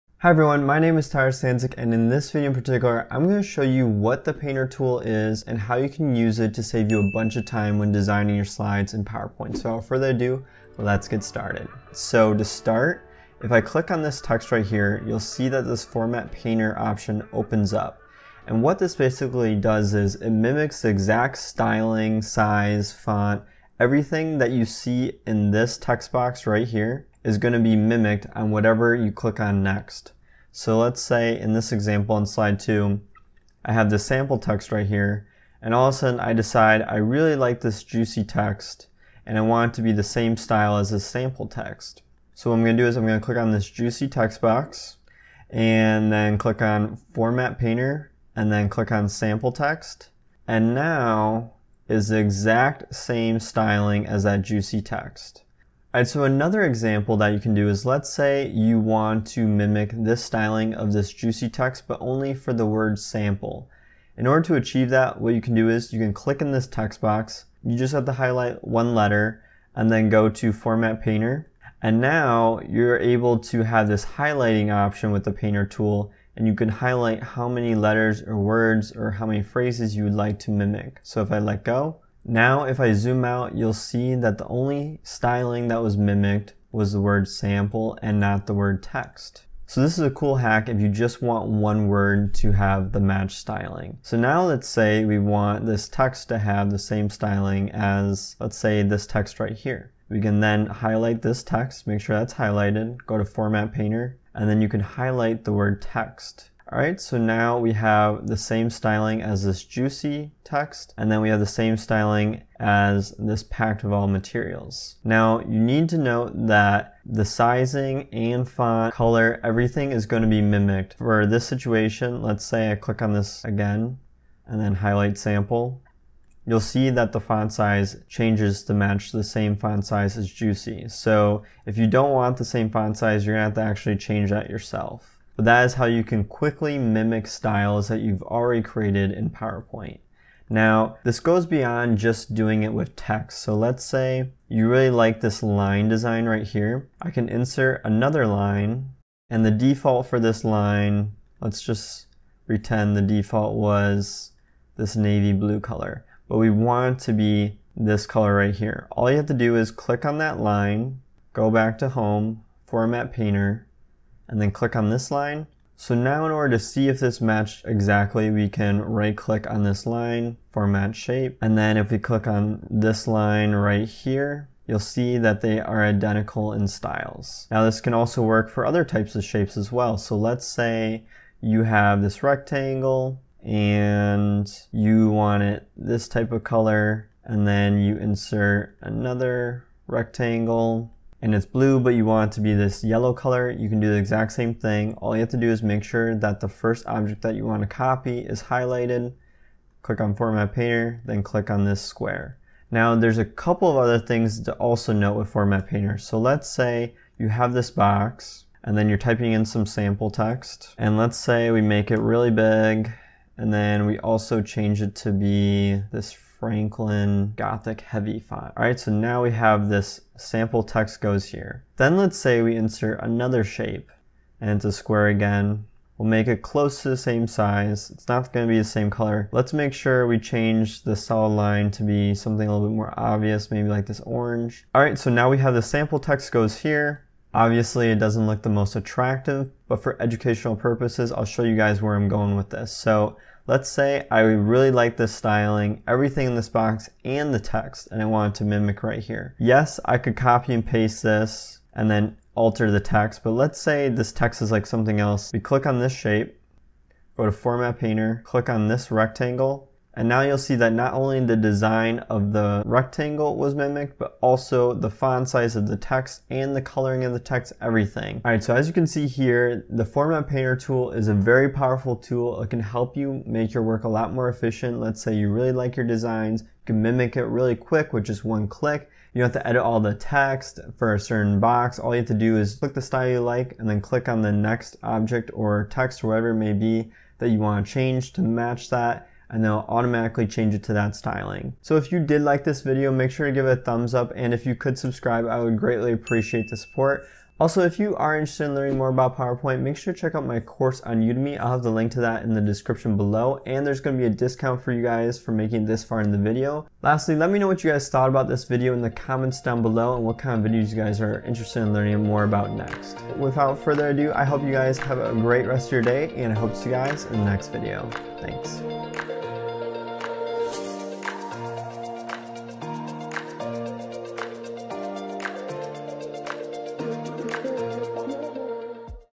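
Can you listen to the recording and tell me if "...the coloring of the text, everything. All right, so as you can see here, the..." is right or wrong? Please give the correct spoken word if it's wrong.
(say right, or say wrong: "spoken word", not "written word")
right.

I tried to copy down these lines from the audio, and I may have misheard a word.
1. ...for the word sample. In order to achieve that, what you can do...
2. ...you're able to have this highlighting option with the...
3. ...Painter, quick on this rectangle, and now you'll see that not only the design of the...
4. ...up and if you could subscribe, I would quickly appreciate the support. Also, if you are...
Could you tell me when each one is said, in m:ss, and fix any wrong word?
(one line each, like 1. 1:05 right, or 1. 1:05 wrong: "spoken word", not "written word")
1. 1:02 right
2. 1:12 right
3. 4:17 wrong: "click", not "quick"
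4. 4:53 wrong: "greatly", not "quickly".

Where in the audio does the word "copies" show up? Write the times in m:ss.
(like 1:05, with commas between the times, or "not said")
not said.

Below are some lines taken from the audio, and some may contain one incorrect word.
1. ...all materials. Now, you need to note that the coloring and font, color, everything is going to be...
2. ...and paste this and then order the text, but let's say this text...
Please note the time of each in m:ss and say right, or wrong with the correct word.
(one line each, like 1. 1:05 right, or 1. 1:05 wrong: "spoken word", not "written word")
1. 1:53 wrong: "sizing", not "coloring"
2. 4:10 wrong: "alter", not "order".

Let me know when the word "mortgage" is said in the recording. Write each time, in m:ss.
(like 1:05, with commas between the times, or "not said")
not said.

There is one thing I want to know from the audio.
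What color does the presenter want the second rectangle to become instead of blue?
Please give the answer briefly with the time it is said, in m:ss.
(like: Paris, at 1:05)
yellow, at 3:12.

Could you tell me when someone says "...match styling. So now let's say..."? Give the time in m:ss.
1:32.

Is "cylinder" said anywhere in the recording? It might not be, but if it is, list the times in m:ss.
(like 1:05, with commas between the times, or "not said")
not said.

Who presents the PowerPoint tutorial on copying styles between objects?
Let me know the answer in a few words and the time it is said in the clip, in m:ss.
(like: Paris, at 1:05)
Tyler Stanczak, at 0:01.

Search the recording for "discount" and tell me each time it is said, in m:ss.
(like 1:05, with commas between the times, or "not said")
5:04.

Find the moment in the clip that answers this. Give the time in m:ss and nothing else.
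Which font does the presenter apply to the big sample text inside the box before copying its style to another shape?
3:36.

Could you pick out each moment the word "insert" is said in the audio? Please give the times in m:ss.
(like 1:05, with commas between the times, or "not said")
2:27, 3:07, 3:42.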